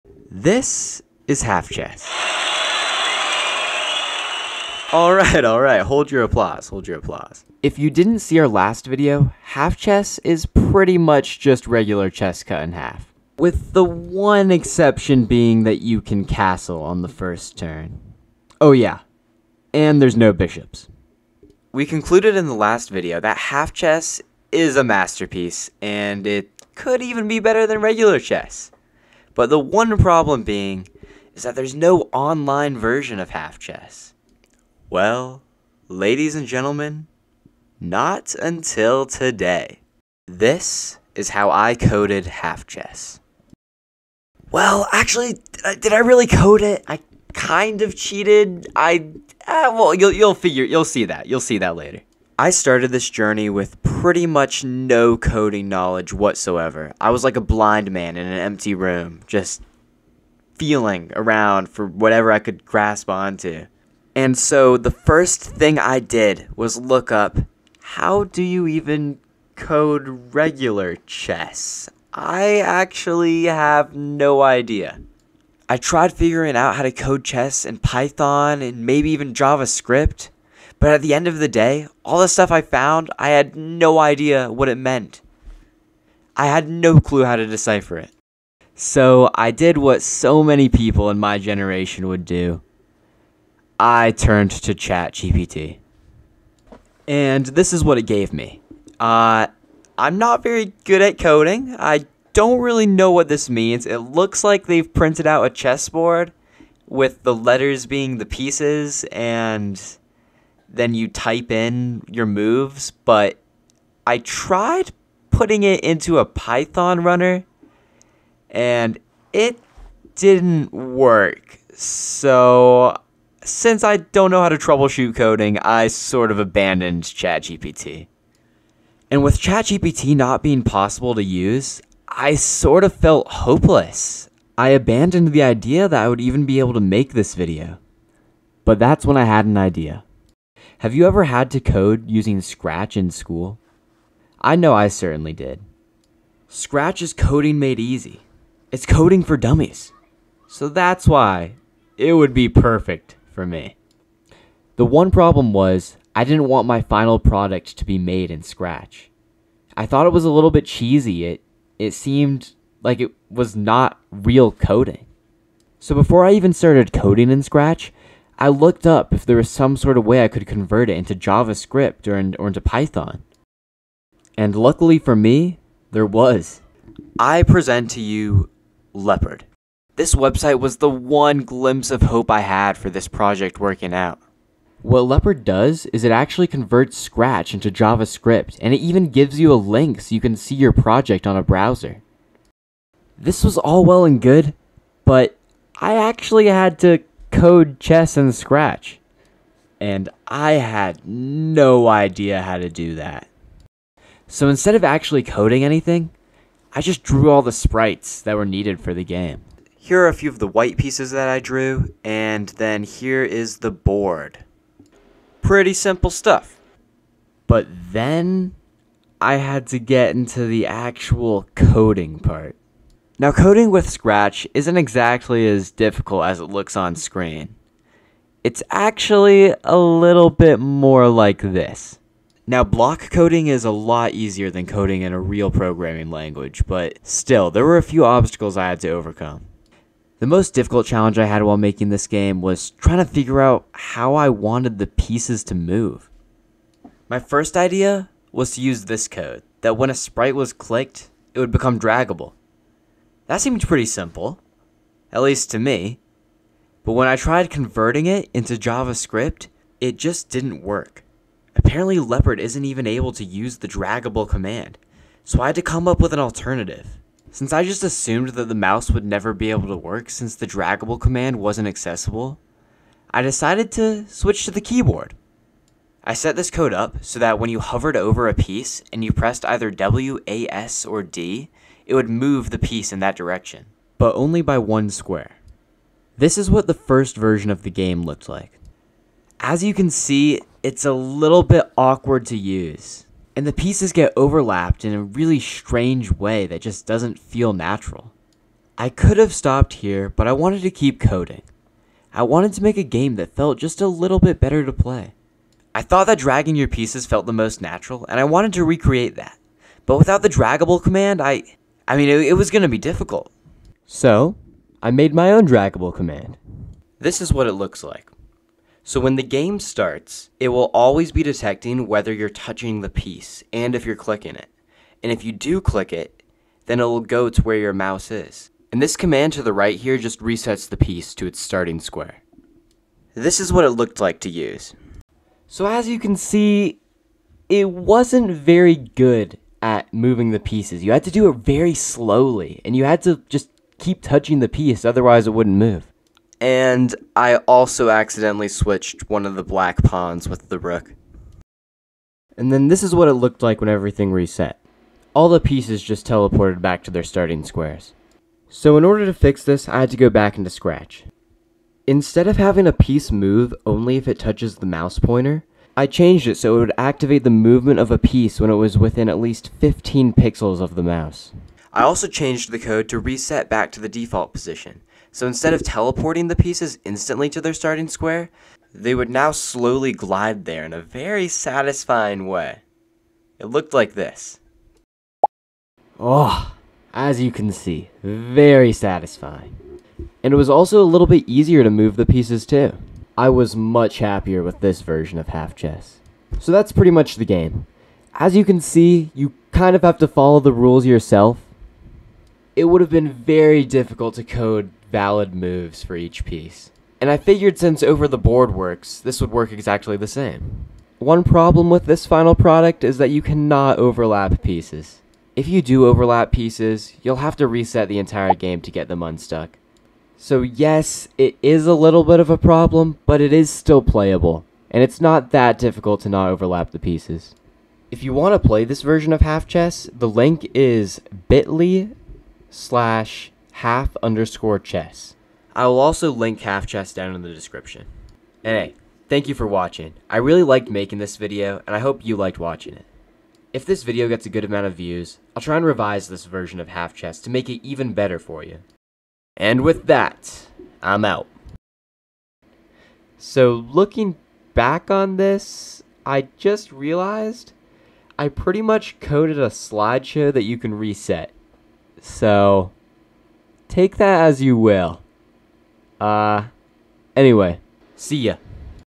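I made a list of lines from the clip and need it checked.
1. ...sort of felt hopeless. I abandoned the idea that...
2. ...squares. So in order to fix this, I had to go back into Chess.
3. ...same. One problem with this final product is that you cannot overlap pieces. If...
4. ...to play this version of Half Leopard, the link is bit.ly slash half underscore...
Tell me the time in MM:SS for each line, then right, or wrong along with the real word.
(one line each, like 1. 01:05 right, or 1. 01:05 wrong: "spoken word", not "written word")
1. 02:12 right
2. 05:57 wrong: "Scratch", not "Chess"
3. 06:50 right
4. 07:08 wrong: "Chess", not "Leopard".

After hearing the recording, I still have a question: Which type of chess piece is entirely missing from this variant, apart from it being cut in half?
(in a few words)
Bishops.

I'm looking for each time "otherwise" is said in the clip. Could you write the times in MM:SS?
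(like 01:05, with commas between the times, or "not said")
05:44.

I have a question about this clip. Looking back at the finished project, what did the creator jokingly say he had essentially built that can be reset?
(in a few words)
A slideshow.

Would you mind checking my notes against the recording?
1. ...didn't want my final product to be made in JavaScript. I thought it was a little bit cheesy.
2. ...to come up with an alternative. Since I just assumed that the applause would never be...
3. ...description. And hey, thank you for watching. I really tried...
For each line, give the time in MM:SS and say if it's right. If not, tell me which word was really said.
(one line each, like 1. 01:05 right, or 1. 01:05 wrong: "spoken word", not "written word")
1. 02:36 wrong: "Scratch", not "JavaScript"
2. 04:25 wrong: "mouse", not "applause"
3. 07:17 wrong: "liked", not "tried".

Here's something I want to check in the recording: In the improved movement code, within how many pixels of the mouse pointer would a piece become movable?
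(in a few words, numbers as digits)
15.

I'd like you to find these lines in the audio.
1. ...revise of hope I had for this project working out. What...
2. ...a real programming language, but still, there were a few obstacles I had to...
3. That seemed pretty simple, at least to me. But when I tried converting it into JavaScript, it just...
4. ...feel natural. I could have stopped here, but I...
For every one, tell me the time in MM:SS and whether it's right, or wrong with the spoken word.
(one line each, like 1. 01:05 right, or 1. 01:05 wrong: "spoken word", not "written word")
1. 03:01 wrong: "glimpse", not "revise"
2. 03:55 right
3. 04:13 right
4. 04:57 right.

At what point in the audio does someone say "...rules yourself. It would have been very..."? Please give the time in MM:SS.
06:40.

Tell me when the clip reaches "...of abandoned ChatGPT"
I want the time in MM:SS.
02:06.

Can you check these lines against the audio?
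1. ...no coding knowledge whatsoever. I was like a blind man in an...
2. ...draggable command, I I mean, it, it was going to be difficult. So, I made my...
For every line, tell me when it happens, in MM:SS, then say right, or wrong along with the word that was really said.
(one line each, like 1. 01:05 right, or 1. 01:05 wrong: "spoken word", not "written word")
1. 00:54 right
2. 05:10 right.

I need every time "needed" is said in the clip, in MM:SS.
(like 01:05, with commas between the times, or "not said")
03:28.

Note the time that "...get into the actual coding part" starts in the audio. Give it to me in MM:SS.
03:39.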